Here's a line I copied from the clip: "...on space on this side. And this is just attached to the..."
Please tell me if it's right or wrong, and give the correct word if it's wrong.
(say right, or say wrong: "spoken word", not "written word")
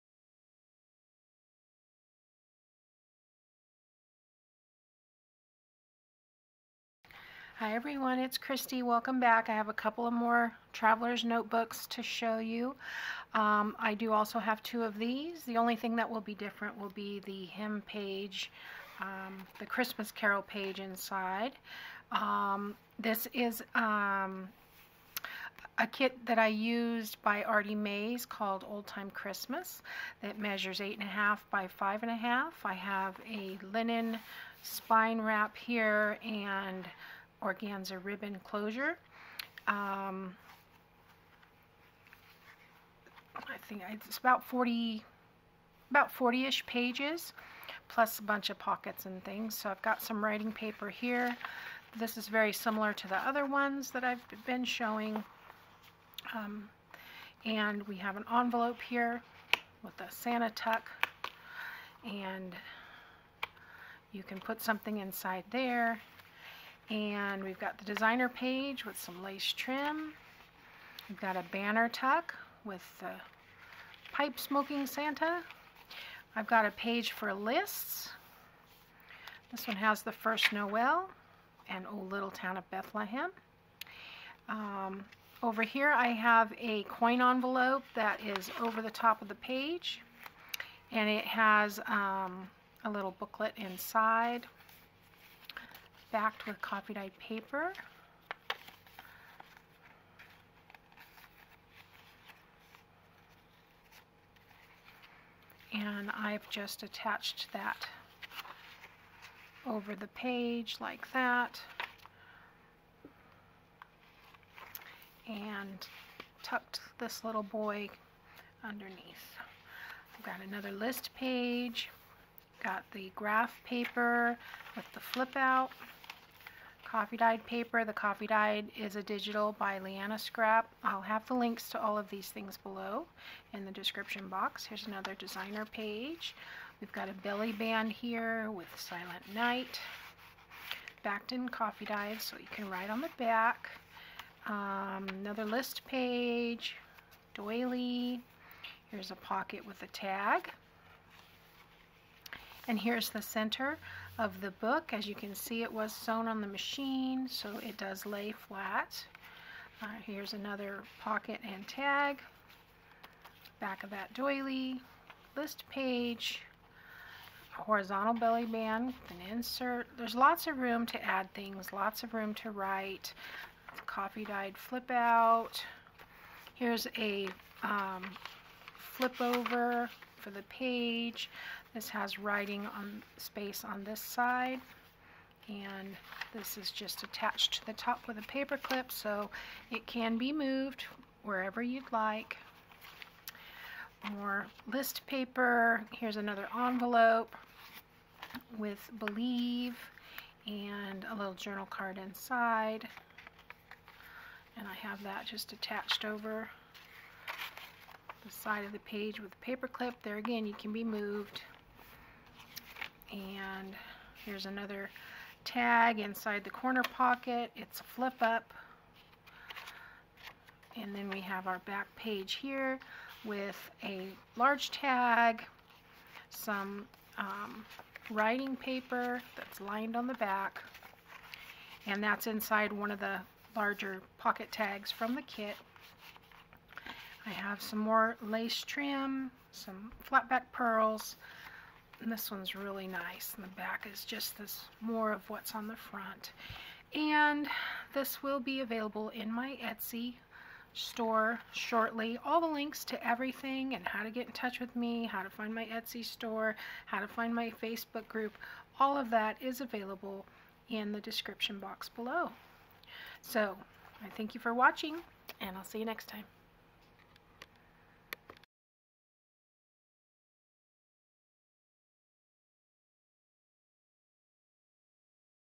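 right.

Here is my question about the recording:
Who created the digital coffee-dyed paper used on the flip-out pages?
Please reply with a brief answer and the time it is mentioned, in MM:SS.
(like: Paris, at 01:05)
Leanna Scrap, at 02:09.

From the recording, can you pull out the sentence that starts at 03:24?
And I have that just attached over the side of the page with a paper clip.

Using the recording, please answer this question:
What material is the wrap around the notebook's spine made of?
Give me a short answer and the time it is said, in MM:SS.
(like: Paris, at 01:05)
Linen, at 00:33.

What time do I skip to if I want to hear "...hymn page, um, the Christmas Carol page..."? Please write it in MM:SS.
00:17.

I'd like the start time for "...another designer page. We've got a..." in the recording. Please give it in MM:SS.
02:14.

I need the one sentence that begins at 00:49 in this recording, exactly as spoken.
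So I've got some writing paper here.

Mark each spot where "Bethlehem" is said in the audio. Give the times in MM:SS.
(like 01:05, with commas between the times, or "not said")
01:22.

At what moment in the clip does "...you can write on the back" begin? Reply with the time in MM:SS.
02:22.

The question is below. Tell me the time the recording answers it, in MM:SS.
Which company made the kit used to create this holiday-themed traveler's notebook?
00:27.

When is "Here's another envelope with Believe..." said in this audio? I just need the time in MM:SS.
03:15.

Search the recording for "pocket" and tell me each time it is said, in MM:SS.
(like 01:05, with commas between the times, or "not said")
00:48, 02:29, 02:40, 03:36, 03:54.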